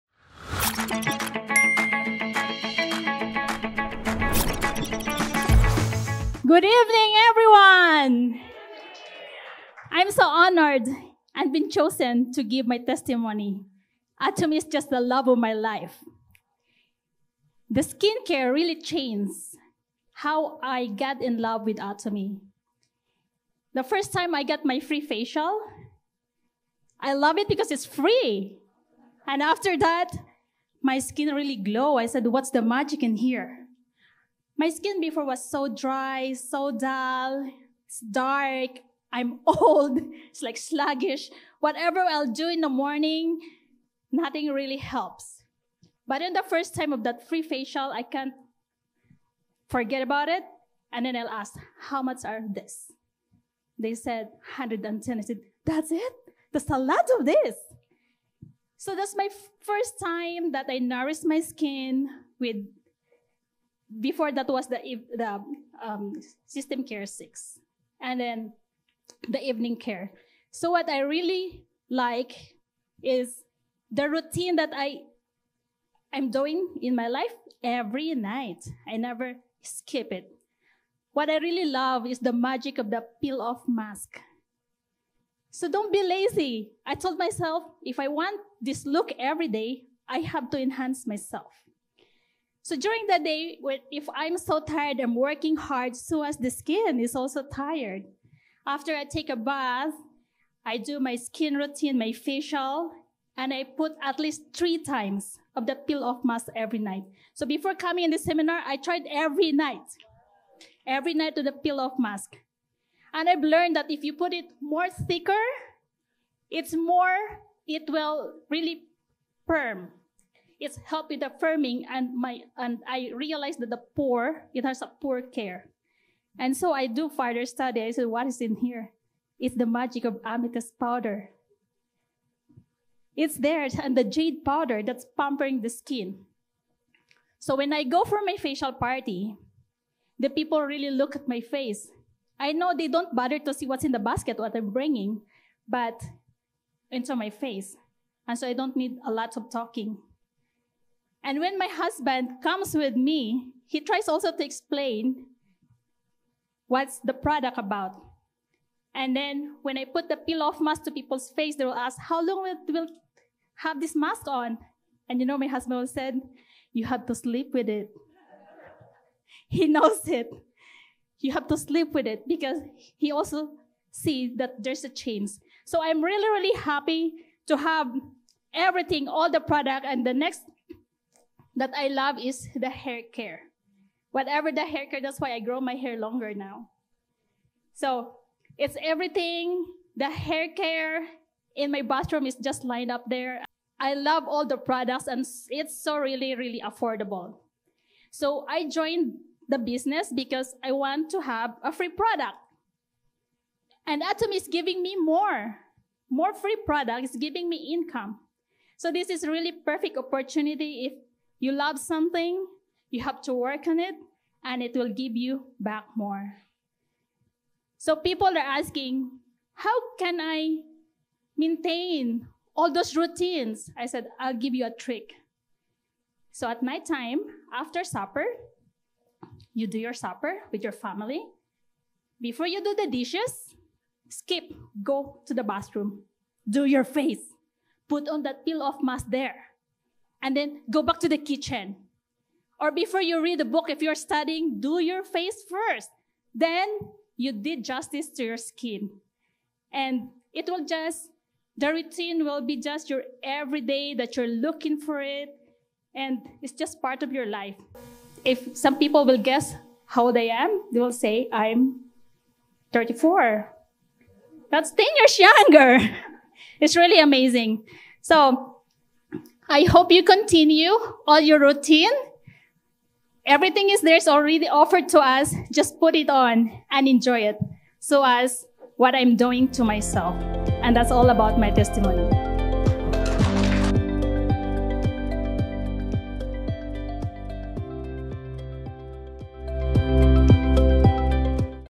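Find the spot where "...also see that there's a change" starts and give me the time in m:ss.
2:53.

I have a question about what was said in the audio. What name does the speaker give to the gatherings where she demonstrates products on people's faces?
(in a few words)
facial party.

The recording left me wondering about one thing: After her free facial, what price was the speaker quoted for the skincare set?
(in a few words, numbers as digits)
110.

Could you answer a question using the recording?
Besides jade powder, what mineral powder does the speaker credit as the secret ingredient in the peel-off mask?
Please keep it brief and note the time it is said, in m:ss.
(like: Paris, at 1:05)
amethyst powder, at 2:10.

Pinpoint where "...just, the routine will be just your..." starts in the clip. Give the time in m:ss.
4:10.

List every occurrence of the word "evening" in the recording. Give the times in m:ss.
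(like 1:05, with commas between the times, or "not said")
0:06, 1:09.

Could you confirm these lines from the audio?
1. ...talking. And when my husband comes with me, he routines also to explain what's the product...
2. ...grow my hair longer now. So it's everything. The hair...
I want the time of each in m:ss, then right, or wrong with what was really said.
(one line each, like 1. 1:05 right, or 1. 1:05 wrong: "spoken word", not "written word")
1. 2:29 wrong: "tries", not "routines"
2. 3:05 right.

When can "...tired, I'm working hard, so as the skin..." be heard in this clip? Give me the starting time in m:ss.
1:34.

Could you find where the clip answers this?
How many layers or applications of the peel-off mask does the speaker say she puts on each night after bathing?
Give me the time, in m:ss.
1:44.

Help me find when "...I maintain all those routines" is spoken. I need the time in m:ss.
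3:40.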